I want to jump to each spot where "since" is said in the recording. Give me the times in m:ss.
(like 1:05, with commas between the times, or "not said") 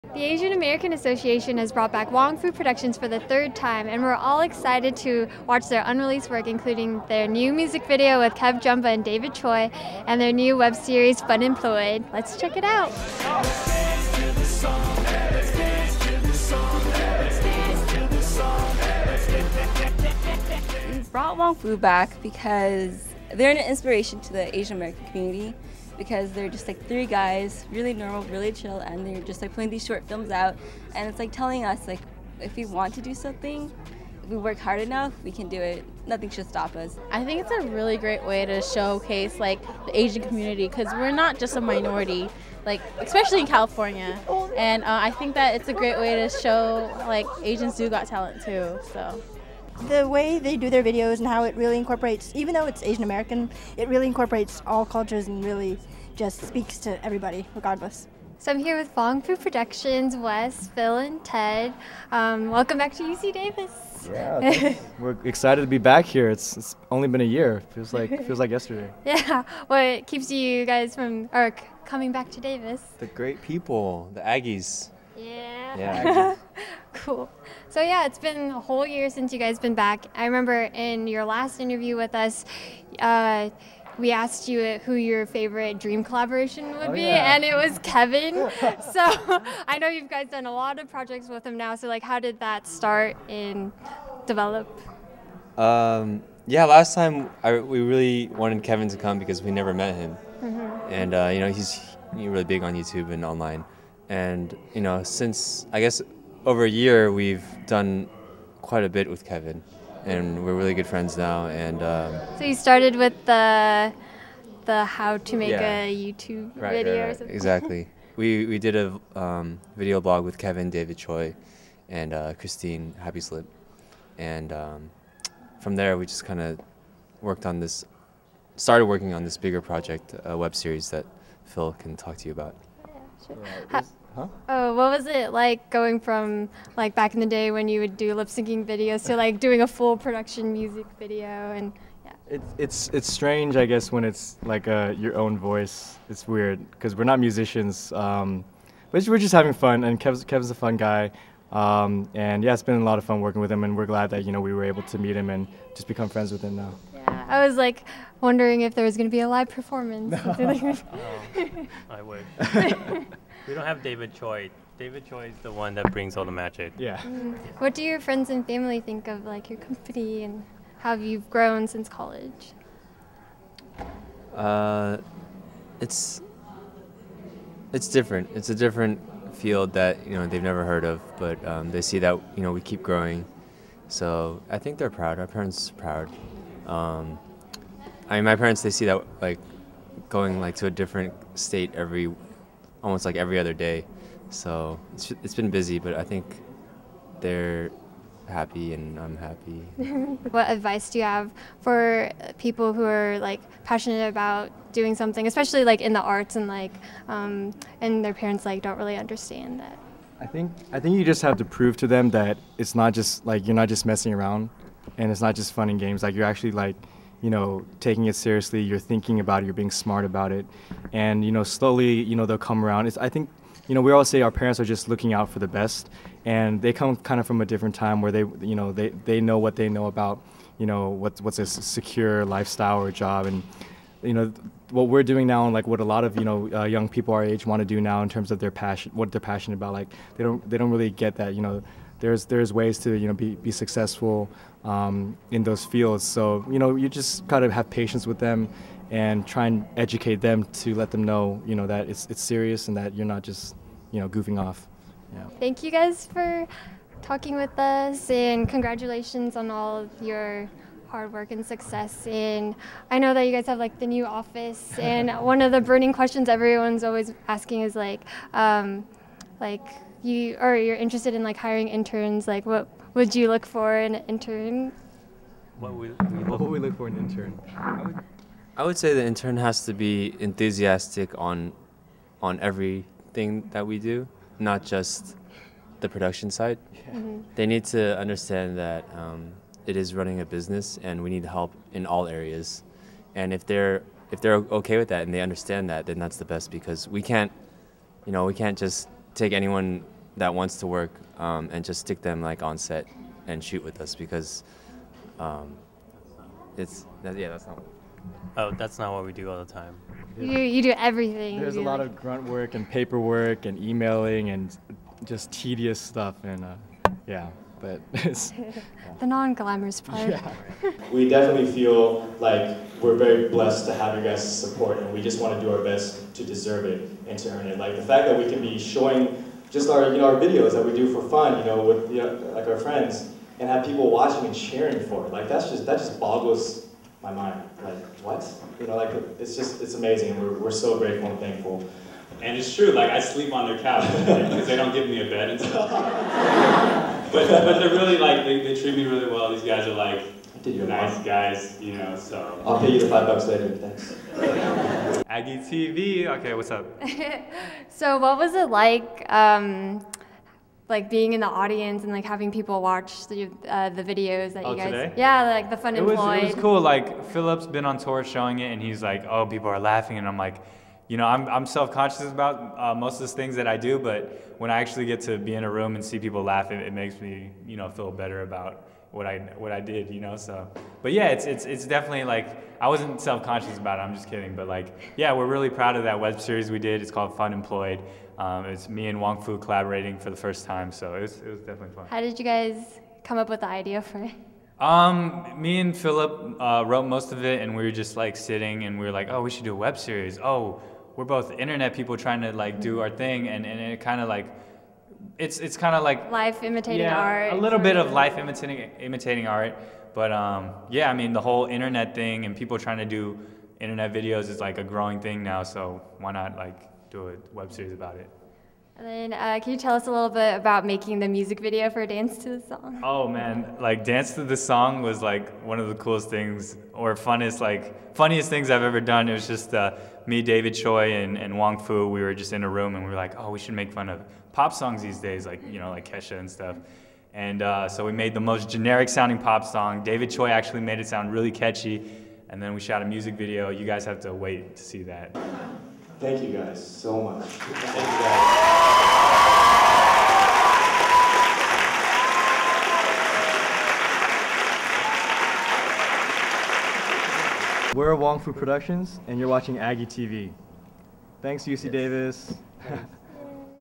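1:19, 1:45, 2:51.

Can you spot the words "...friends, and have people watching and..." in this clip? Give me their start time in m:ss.
5:32.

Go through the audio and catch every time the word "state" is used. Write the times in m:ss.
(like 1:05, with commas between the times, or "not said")
3:11.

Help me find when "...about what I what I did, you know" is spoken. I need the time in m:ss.
6:18.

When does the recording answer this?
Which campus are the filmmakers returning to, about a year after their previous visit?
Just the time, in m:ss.
1:03.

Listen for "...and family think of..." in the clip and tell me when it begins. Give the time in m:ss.
2:48.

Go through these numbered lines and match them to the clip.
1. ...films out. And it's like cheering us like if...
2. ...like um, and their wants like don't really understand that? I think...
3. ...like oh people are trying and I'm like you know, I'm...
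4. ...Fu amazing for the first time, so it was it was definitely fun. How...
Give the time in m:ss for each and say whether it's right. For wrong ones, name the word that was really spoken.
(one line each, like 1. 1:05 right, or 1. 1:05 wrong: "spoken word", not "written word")
1. 0:30 wrong: "telling", not "cheering"
2. 3:26 wrong: "parents", not "wants"
3. 6:08 wrong: "laughing", not "trying"
4. 6:29 wrong: "collaborating", not "amazing".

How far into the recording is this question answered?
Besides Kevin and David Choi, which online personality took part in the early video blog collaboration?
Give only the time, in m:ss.
2:02.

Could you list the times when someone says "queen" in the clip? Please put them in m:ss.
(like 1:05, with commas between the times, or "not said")
not said.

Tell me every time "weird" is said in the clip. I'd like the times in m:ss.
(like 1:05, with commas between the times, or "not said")
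2:26.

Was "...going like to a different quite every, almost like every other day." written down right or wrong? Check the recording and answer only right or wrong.
wrong.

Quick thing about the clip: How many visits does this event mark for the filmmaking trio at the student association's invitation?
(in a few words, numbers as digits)
third.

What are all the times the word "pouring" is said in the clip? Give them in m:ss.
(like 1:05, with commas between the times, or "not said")
not said.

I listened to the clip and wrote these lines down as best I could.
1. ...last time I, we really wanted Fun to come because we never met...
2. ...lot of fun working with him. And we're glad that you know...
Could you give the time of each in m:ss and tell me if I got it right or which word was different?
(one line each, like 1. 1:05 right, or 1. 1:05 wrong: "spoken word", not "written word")
1. 1:36 wrong: "Kevin", not "Fun"
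2. 2:32 right.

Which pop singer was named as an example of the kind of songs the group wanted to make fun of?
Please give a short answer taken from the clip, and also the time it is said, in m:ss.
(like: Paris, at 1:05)
Kesha, at 7:15.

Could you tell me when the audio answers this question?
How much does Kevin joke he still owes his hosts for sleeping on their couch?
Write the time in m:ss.
5:52.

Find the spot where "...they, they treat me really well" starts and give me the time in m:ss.
5:48.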